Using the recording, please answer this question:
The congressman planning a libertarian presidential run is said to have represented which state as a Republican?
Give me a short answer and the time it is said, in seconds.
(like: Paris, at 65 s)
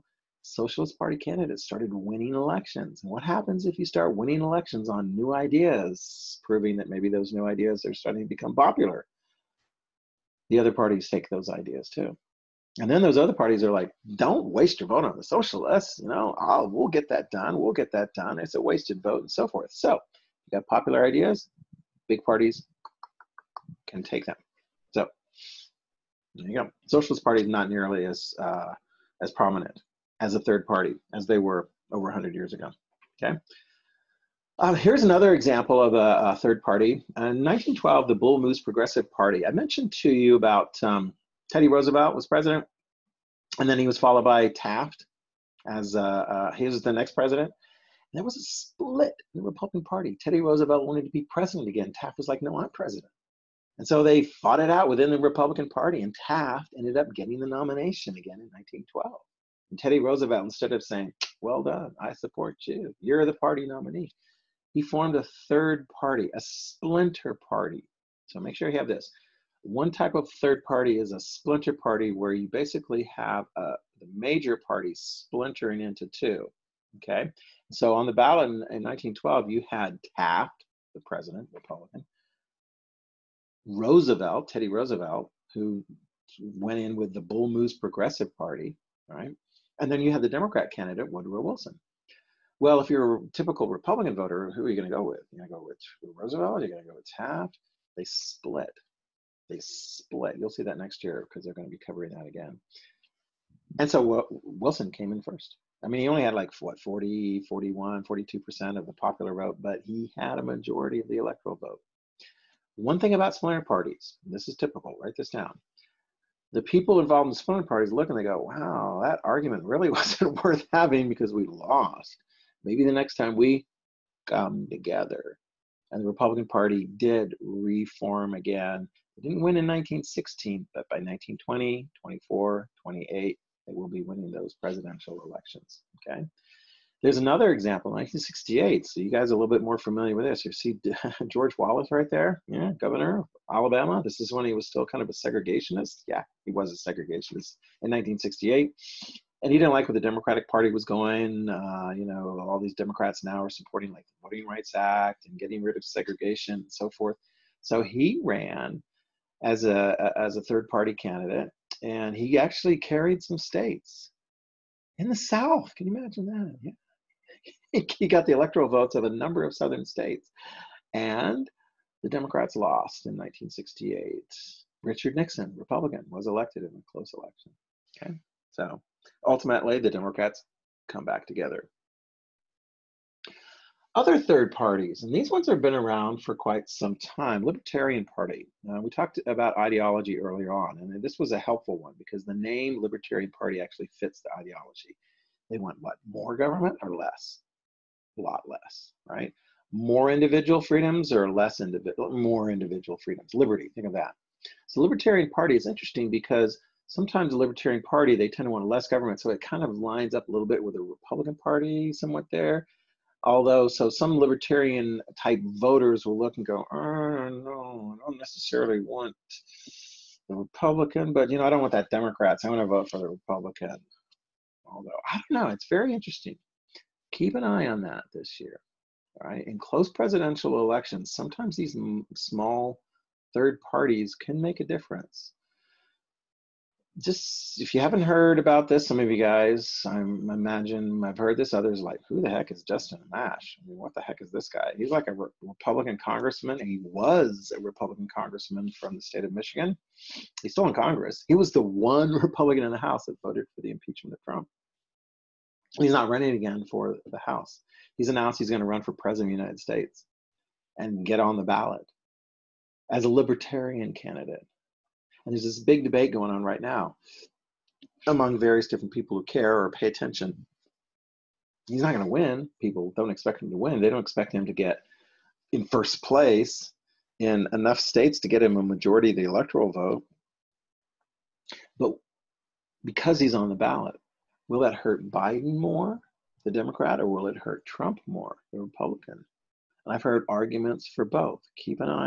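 Michigan, at 249 s.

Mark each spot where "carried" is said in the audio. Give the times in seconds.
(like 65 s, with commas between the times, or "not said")
162 s.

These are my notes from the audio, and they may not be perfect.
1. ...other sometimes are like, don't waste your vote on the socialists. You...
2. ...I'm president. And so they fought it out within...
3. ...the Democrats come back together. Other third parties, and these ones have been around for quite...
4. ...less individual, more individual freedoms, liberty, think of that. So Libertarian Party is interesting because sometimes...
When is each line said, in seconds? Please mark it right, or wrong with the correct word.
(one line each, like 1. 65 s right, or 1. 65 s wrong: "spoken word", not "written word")
1. 13 s wrong: "parties", not "sometimes"
2. 52 s right
3. 179 s right
4. 201 s right.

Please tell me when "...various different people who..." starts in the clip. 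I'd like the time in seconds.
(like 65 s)
268 s.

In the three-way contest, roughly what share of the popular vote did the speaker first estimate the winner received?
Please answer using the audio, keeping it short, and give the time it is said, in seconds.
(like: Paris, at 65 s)
40%, at 106 s.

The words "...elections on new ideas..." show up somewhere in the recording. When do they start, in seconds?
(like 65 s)
4 s.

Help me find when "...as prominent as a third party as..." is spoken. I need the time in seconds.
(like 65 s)
29 s.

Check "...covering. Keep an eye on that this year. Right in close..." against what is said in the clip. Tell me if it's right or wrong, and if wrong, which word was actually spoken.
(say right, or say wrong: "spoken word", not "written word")
wrong: "interesting", not "covering".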